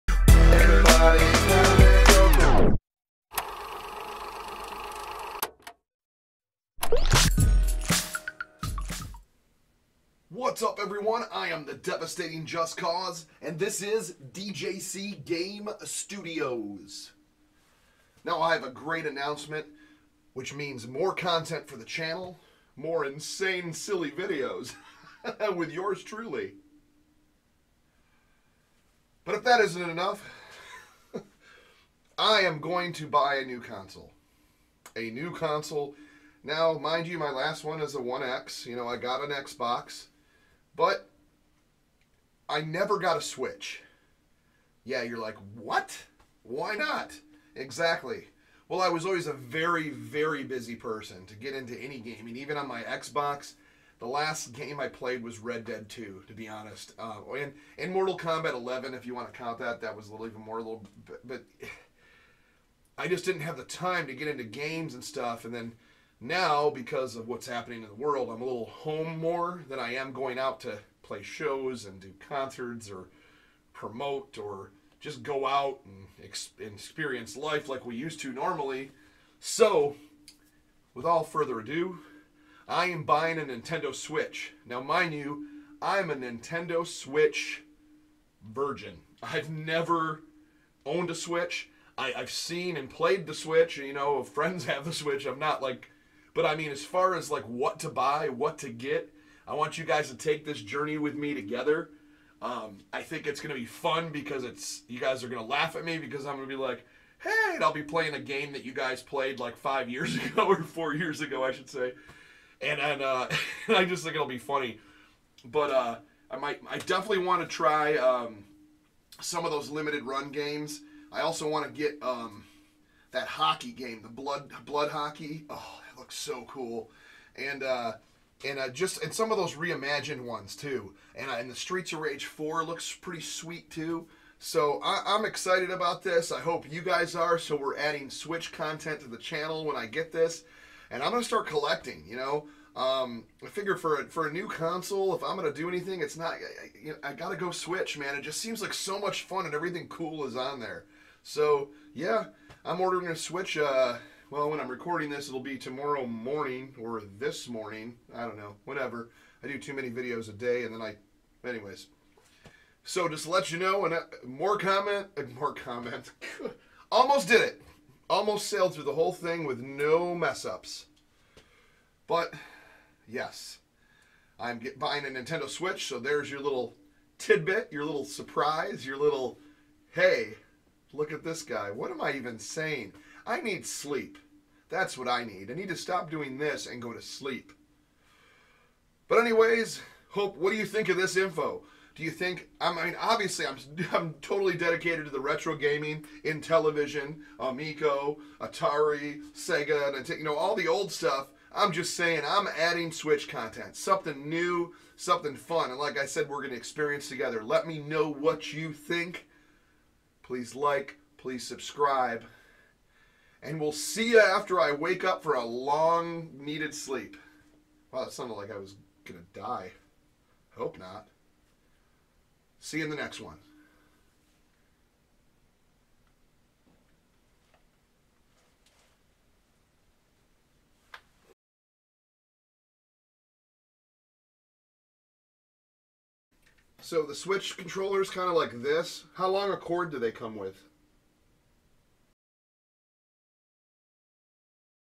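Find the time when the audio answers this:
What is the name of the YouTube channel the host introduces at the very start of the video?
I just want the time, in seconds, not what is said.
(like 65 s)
14 s.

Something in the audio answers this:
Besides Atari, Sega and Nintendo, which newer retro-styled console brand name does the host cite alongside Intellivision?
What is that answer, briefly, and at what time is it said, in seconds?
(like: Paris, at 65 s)
Amico, at 197 s.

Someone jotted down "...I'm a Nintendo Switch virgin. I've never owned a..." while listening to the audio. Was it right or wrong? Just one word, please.
right.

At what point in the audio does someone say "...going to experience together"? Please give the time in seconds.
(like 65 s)
206 s.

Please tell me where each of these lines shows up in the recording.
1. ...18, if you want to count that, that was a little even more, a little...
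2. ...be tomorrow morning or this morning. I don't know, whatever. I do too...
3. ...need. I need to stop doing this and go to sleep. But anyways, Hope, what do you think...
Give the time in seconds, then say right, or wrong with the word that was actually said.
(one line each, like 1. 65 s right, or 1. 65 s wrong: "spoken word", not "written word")
1. 58 s wrong: "11", not "18"
2. 155 s right
3. 185 s right.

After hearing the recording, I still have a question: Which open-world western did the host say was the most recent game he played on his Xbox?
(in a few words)
Red Dead 2.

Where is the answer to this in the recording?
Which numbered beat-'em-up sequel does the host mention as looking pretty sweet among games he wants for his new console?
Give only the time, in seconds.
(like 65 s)
131 s.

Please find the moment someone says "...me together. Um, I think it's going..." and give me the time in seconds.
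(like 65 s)
101 s.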